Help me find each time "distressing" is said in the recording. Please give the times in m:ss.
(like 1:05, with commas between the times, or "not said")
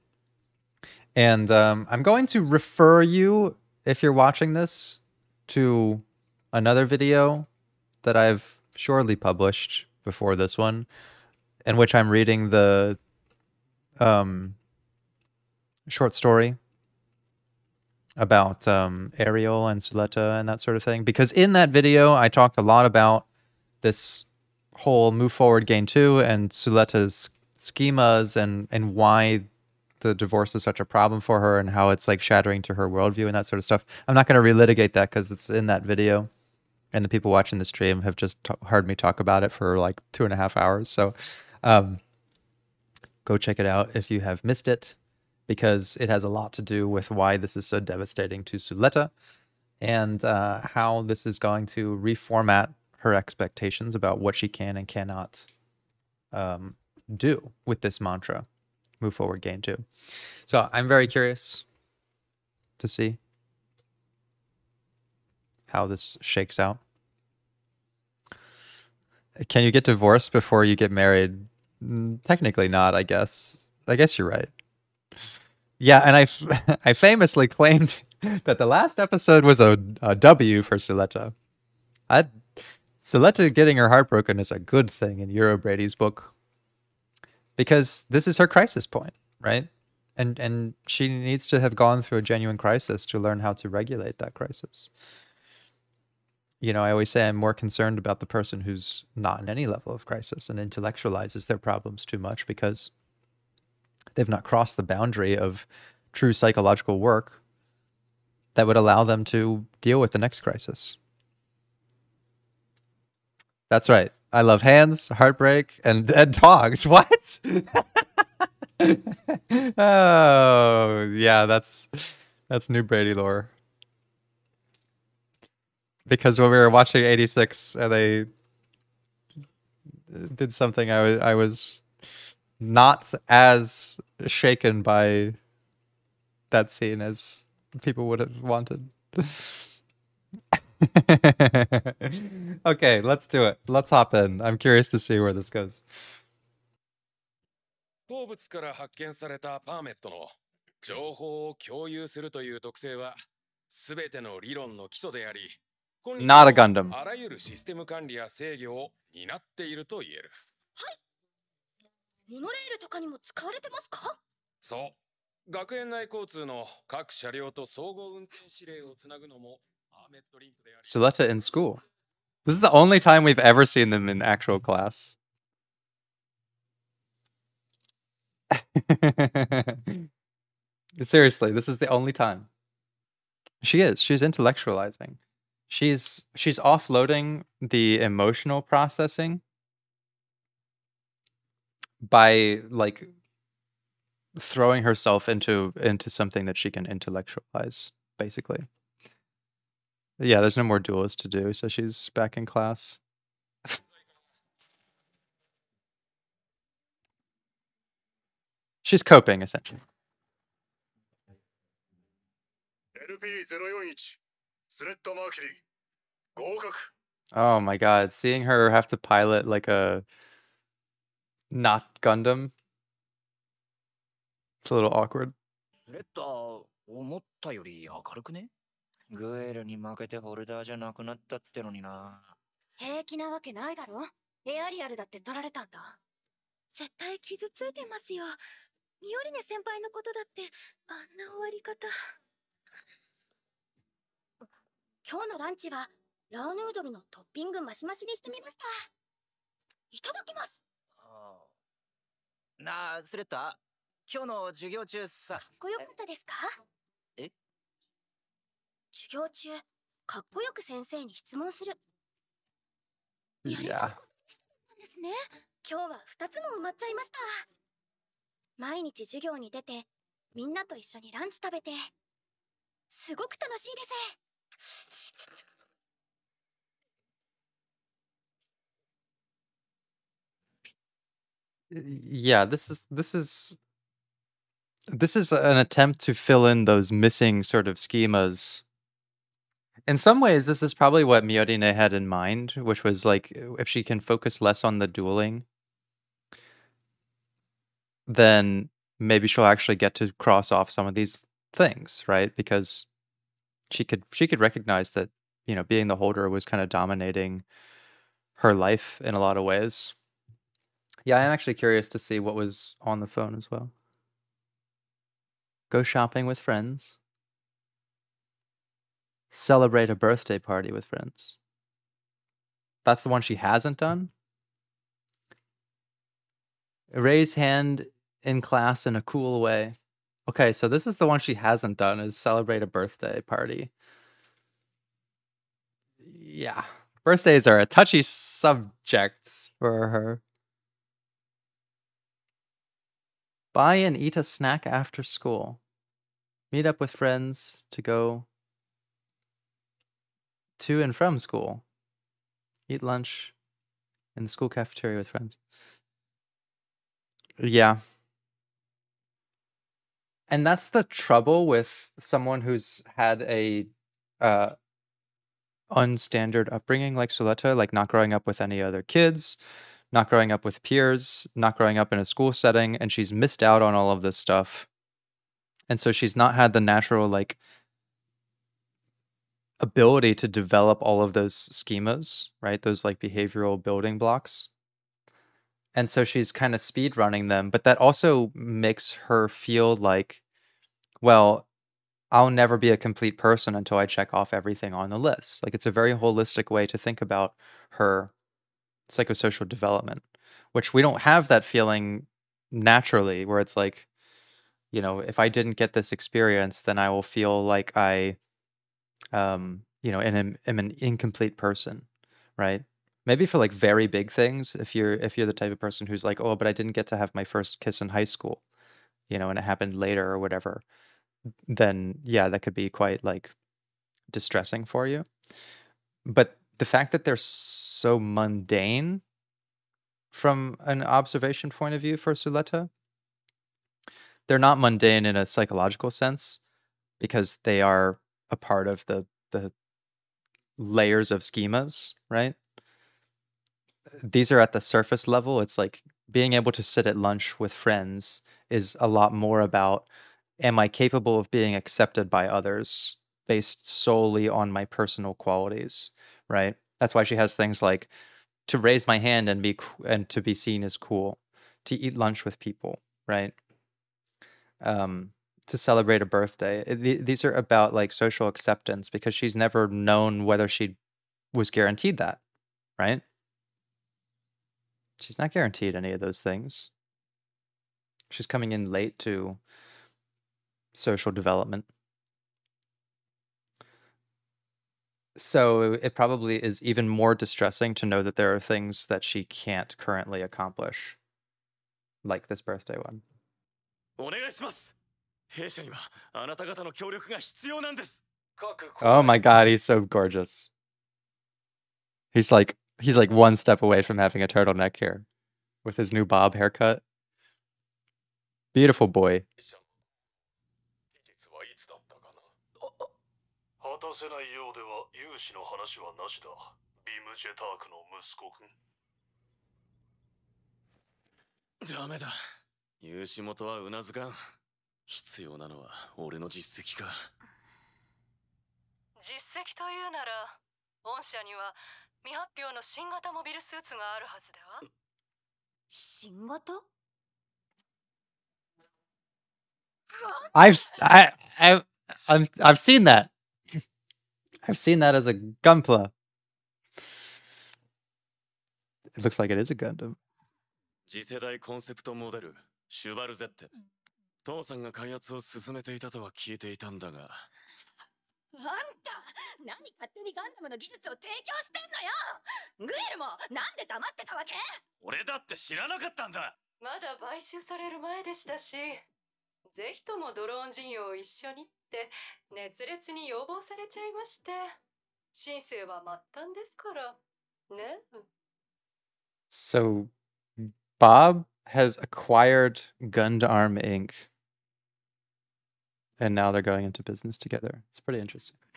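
7:04, 8:07.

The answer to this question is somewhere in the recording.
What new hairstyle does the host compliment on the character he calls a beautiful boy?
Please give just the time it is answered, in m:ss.
8:26.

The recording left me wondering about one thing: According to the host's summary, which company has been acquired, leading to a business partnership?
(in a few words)
Gundam Inc.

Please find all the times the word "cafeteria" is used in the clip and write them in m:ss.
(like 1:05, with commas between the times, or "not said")
5:54.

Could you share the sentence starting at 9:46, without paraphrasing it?
and now they're going into business together.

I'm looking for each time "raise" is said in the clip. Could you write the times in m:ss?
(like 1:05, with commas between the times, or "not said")
5:26, 7:38.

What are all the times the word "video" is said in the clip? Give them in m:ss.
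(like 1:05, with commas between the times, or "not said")
0:06, 0:21, 0:35.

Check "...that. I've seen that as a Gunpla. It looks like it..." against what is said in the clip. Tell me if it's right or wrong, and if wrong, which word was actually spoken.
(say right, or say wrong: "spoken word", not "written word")
right.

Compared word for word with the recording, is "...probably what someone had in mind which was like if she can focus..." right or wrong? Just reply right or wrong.
wrong.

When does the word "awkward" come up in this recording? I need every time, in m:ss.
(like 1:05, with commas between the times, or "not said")
3:44.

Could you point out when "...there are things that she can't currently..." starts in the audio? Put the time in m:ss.
8:08.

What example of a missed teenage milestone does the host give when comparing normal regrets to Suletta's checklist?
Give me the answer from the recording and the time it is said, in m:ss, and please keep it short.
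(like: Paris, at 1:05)
First kiss, at 6:57.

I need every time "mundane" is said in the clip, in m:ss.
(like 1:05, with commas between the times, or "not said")
7:07, 7:14.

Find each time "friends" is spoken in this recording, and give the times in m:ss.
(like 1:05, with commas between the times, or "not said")
5:16, 5:20, 5:46, 5:55, 7:27.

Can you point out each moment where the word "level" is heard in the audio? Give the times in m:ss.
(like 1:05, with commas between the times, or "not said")
1:39, 7:25.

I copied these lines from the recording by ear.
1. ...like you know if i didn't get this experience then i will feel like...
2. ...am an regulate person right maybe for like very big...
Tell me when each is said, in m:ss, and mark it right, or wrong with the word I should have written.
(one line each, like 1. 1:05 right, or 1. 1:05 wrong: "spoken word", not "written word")
1. 6:43 right
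2. 6:50 wrong: "incomplete", not "regulate".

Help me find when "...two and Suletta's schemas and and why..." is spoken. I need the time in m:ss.
0:25.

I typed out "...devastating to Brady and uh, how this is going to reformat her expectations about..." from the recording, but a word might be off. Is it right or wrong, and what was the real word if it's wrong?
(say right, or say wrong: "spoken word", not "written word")
wrong: "Suletta", not "Brady".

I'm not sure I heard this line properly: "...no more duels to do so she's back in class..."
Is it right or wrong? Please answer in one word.
right.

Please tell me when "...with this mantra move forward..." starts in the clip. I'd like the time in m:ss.
0:57.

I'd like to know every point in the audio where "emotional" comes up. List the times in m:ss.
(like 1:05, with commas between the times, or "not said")
3:08.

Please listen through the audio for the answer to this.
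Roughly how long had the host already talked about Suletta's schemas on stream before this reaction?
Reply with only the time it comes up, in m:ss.
0:40.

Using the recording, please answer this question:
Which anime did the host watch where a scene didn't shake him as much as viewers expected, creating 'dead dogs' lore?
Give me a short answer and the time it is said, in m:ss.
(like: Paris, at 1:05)
86, at 2:07.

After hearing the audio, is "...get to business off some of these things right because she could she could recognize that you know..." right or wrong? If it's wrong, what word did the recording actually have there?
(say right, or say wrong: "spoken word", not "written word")
wrong: "cross", not "business".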